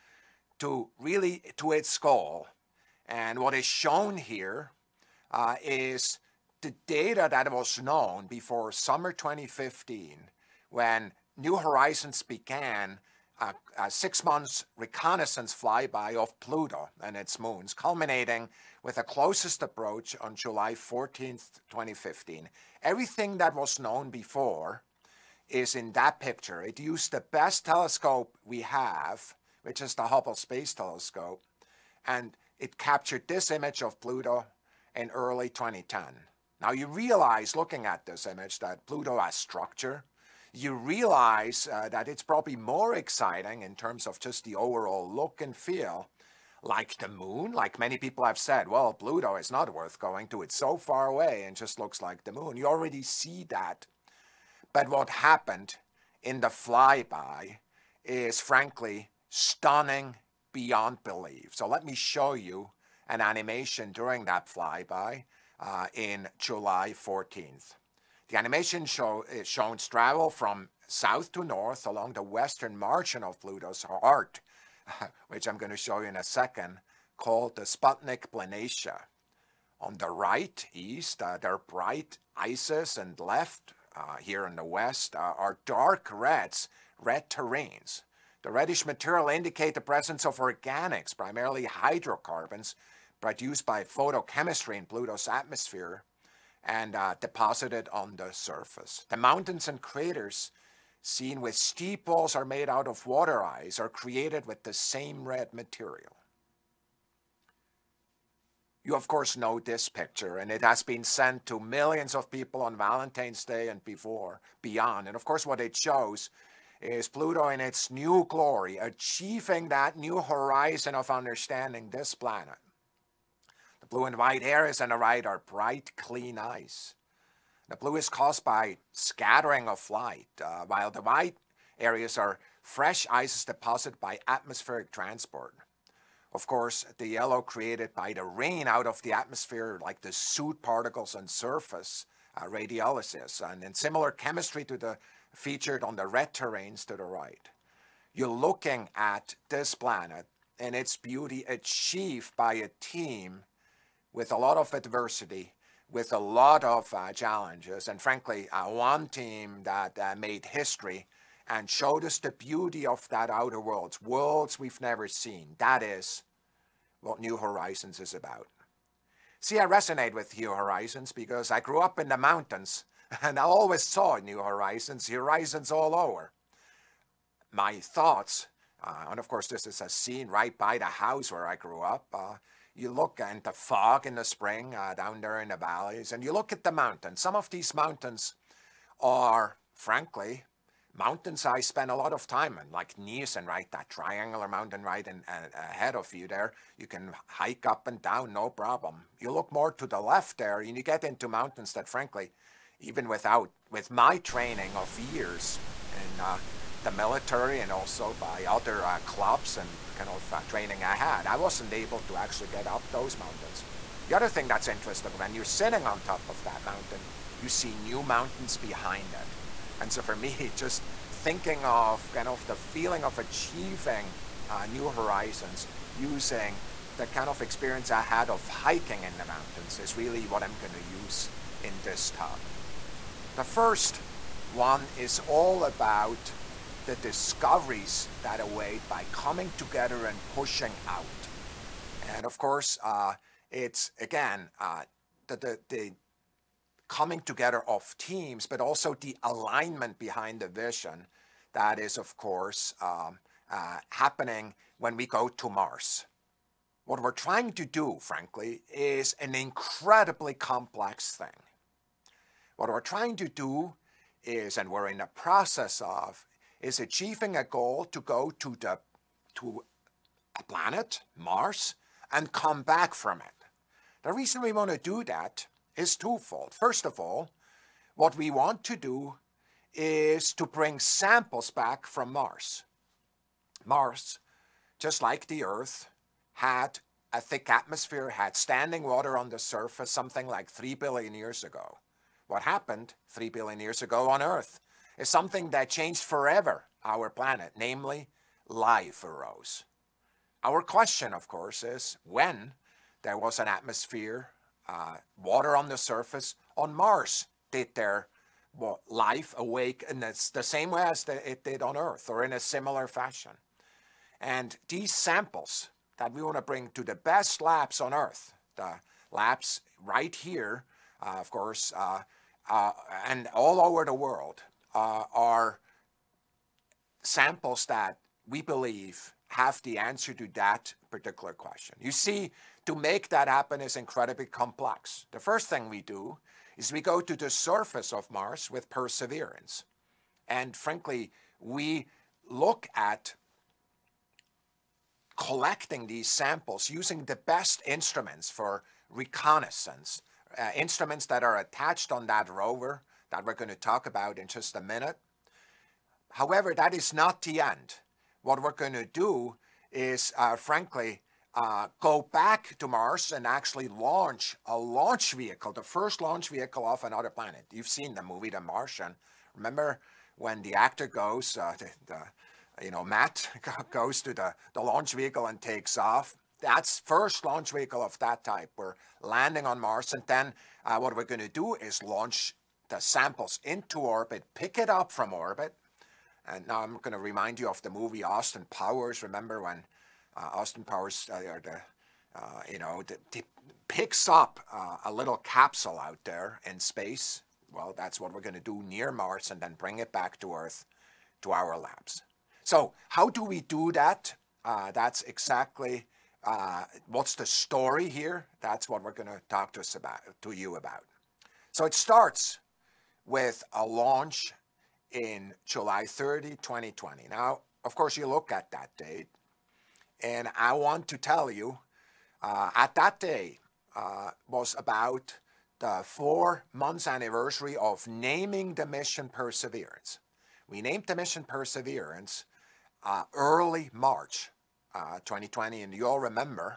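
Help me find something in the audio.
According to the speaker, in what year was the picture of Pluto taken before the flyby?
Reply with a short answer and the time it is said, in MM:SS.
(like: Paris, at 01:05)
2010, at 00:35.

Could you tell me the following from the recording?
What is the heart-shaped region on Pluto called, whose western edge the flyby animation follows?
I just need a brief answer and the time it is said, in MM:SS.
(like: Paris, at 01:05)
Sputnik Planitia, at 01:17.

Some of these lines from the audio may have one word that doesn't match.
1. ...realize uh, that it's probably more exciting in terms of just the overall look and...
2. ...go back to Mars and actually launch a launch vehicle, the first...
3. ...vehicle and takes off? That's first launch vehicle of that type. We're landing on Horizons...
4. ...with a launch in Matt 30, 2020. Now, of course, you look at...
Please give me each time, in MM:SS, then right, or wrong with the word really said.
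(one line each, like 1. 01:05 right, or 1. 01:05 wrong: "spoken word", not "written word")
1. 00:40 right
2. 06:01 right
3. 06:14 wrong: "Mars", not "Horizons"
4. 06:53 wrong: "July", not "Matt".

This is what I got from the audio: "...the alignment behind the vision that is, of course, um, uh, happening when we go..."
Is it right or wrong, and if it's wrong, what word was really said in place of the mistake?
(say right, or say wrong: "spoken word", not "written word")
right.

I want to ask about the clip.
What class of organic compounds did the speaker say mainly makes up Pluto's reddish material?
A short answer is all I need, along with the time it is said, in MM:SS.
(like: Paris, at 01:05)
Hydrocarbons, at 01:31.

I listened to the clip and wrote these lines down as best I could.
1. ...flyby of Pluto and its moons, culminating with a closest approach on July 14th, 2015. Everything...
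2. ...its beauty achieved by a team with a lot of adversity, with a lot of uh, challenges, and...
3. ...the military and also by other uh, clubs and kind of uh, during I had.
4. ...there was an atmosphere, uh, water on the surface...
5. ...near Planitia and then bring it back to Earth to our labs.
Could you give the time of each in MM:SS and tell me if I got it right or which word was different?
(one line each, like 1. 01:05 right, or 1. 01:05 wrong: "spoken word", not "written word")
1. 00:15 right
2. 02:30 right
3. 03:26 wrong: "training", not "during"
4. 05:03 right
5. 06:38 wrong: "Mars", not "Planitia".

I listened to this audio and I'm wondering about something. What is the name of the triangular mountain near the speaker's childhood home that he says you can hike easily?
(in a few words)
Niesen.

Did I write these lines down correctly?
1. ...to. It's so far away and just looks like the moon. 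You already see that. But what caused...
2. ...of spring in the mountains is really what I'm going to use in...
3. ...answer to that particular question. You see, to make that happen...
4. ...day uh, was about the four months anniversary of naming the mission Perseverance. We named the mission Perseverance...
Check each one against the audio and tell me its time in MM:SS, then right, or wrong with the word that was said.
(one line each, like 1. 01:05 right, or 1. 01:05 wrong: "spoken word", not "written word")
1. 00:50 wrong: "happened", not "caused"
2. 03:48 wrong: "hiking", not "spring"
3. 05:29 right
4. 07:02 right.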